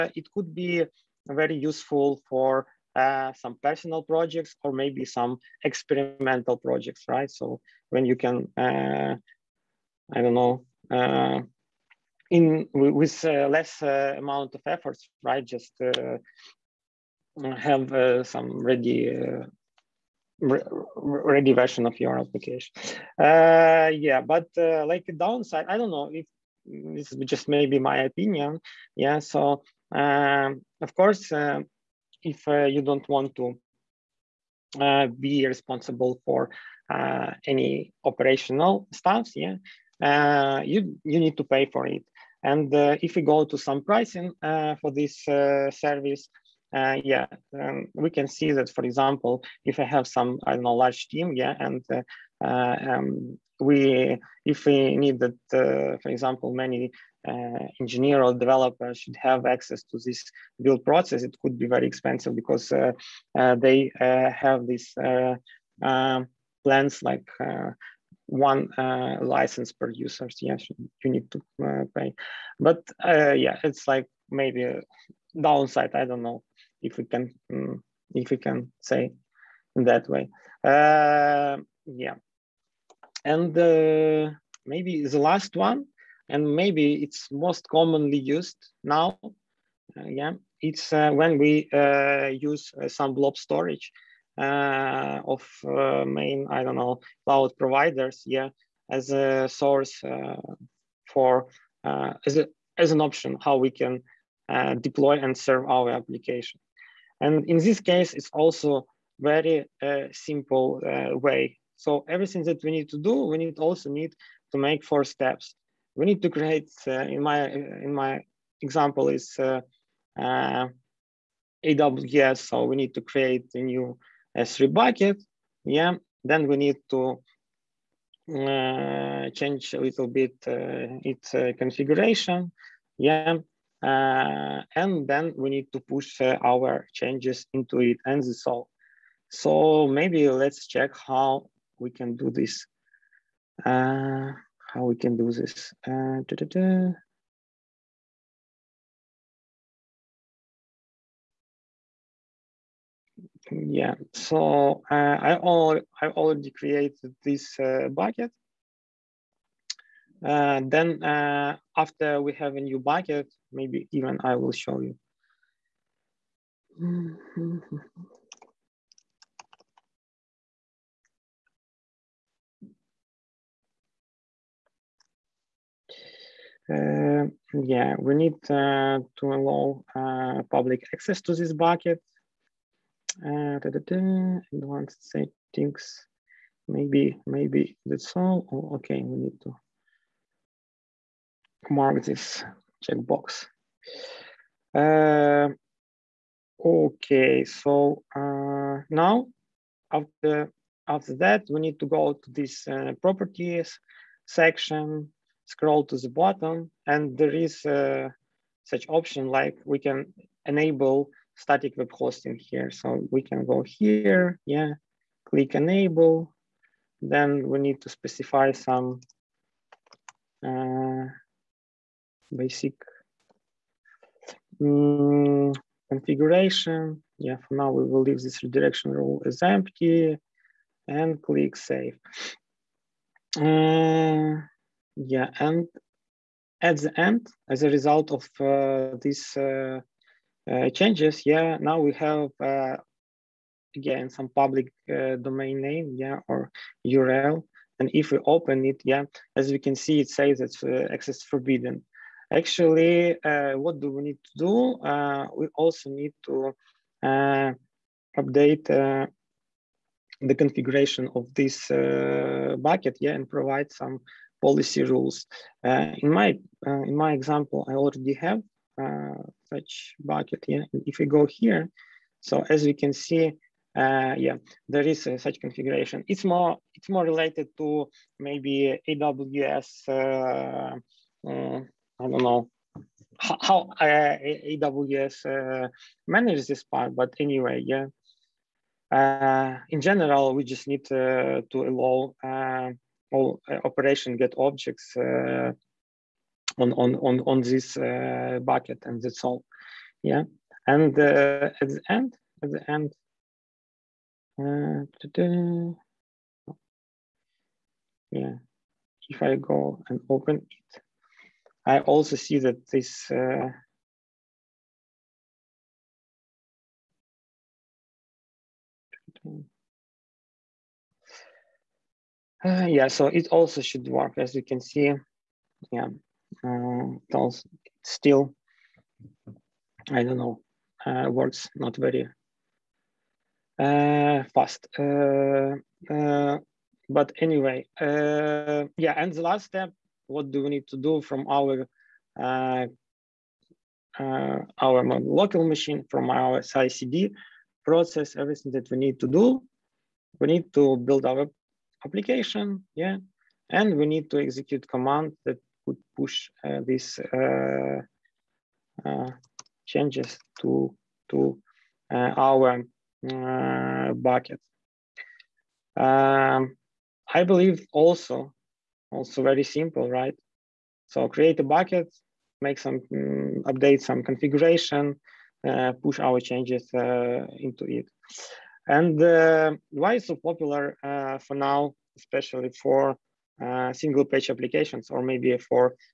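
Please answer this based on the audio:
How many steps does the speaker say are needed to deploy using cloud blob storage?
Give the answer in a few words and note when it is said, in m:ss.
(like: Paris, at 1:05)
4, at 1:54.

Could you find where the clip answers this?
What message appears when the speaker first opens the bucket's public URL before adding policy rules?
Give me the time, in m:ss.
4:10.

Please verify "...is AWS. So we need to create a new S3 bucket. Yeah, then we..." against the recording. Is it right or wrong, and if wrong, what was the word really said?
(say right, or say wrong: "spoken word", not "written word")
right.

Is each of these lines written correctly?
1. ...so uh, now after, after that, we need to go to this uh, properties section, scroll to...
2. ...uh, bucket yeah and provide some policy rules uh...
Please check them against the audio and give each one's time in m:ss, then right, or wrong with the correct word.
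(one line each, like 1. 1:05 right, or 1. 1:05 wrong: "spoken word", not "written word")
1. 3:17 right
2. 4:21 right.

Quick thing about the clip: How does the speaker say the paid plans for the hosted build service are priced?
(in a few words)
One license per user.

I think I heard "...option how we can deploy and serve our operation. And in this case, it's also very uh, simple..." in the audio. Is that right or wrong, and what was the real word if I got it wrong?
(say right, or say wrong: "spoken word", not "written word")
wrong: "application", not "operation".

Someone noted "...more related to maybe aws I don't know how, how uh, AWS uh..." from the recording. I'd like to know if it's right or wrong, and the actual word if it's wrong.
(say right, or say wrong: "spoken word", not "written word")
right.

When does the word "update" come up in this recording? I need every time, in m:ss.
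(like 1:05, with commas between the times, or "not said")
4:18, 6:13.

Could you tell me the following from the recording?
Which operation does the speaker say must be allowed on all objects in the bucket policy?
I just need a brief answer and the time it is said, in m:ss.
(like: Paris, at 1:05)
Get objects, at 4:54.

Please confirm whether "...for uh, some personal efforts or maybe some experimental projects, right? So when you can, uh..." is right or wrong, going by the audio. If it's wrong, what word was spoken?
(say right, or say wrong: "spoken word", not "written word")
wrong: "projects", not "efforts".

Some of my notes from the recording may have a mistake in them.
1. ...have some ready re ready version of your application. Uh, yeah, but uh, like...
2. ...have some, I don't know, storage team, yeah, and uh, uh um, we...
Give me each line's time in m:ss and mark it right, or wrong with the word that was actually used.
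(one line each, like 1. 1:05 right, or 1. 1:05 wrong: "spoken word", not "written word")
1. 0:17 right
2. 0:49 wrong: "large", not "storage".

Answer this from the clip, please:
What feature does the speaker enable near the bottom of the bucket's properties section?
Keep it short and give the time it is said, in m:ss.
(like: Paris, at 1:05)
Static web hosting, at 3:31.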